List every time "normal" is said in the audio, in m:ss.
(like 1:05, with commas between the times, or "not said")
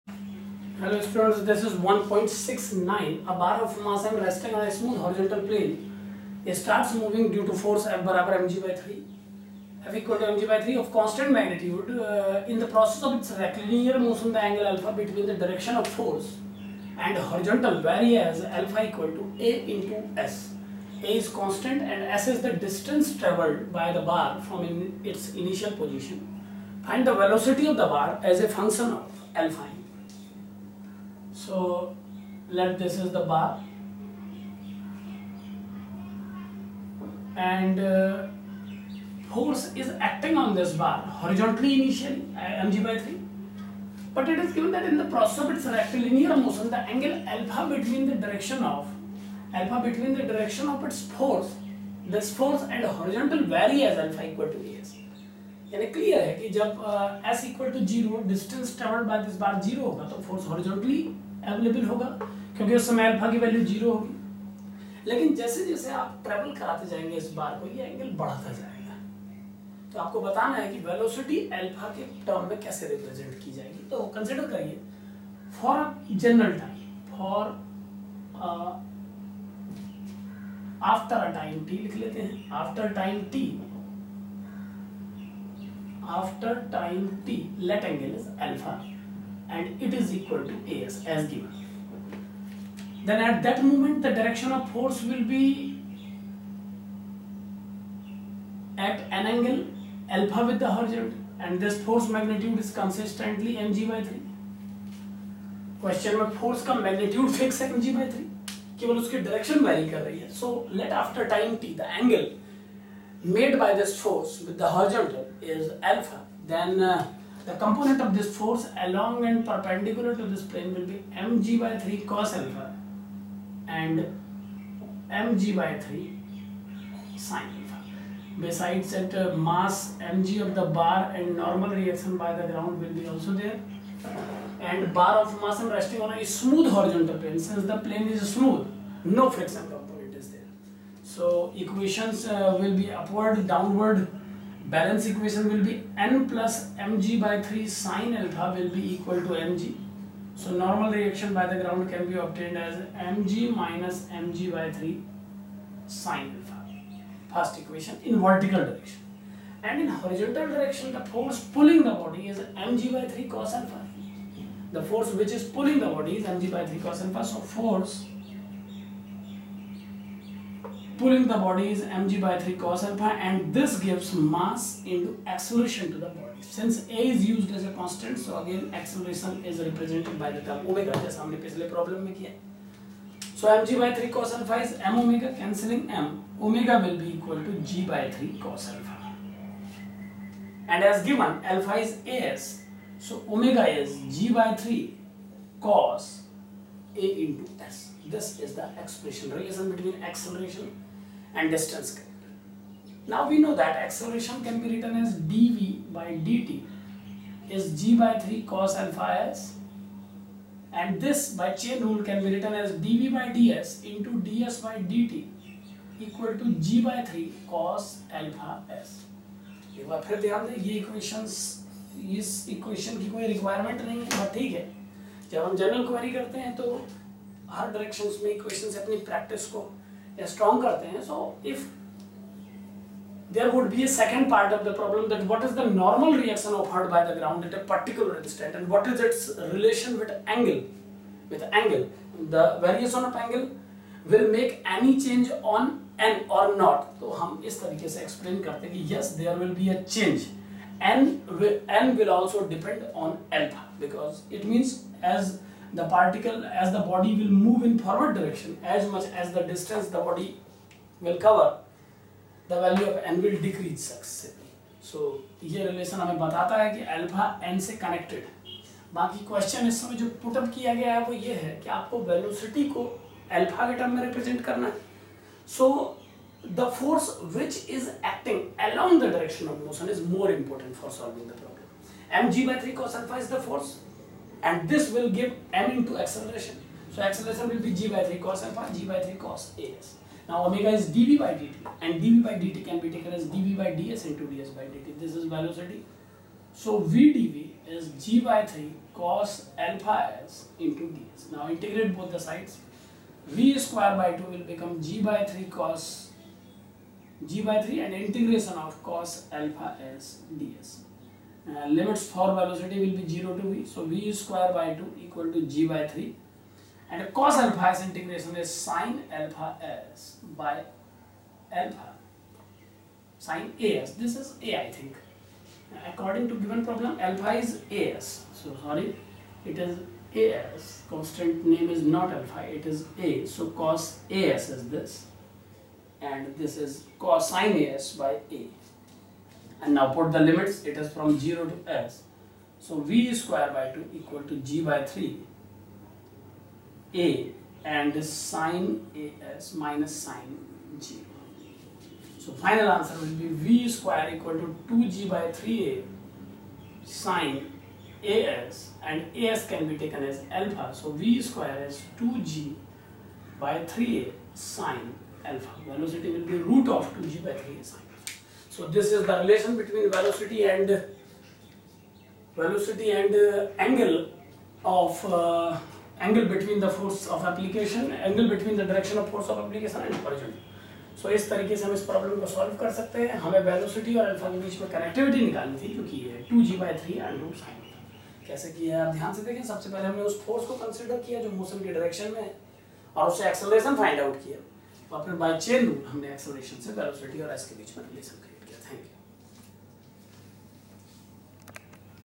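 2:11, 2:30, 3:55.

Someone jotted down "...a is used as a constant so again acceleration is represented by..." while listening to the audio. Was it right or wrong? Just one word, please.
right.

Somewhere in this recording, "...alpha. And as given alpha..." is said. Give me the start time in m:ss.
3:08.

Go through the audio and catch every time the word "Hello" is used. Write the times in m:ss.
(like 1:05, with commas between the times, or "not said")
0:00.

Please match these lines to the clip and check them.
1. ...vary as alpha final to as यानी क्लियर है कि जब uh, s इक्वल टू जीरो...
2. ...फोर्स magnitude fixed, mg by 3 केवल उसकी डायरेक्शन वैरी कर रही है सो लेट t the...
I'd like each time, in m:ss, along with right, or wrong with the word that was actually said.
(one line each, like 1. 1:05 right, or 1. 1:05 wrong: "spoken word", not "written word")
1. 0:53 wrong: "equal", not "final"
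2. 1:46 right.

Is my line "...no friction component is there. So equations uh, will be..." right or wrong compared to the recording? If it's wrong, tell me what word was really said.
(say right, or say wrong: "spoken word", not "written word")
right.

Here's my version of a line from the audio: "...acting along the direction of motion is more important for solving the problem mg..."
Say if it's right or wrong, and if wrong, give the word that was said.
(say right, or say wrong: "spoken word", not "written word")
right.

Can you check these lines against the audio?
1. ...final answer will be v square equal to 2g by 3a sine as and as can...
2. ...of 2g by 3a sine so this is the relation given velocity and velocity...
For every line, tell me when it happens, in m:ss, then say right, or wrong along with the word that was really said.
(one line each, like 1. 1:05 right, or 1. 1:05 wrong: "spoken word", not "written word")
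1. 5:52 right
2. 6:06 wrong: "between", not "given".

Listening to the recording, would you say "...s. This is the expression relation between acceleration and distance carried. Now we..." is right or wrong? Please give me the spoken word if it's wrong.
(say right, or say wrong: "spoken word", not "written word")
right.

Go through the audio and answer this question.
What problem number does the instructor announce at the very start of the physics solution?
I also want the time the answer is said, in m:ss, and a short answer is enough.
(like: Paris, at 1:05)
1.69, at 0:01.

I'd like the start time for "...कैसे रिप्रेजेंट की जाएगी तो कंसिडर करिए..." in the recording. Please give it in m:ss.
1:12.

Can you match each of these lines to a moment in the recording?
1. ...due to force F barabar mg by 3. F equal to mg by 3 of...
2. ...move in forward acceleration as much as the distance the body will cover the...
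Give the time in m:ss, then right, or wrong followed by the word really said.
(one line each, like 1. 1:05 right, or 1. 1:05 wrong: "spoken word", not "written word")
1. 0:07 right
2. 4:17 wrong: "direction", not "acceleration".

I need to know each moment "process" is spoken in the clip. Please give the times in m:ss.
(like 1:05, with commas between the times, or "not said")
0:12, 0:45.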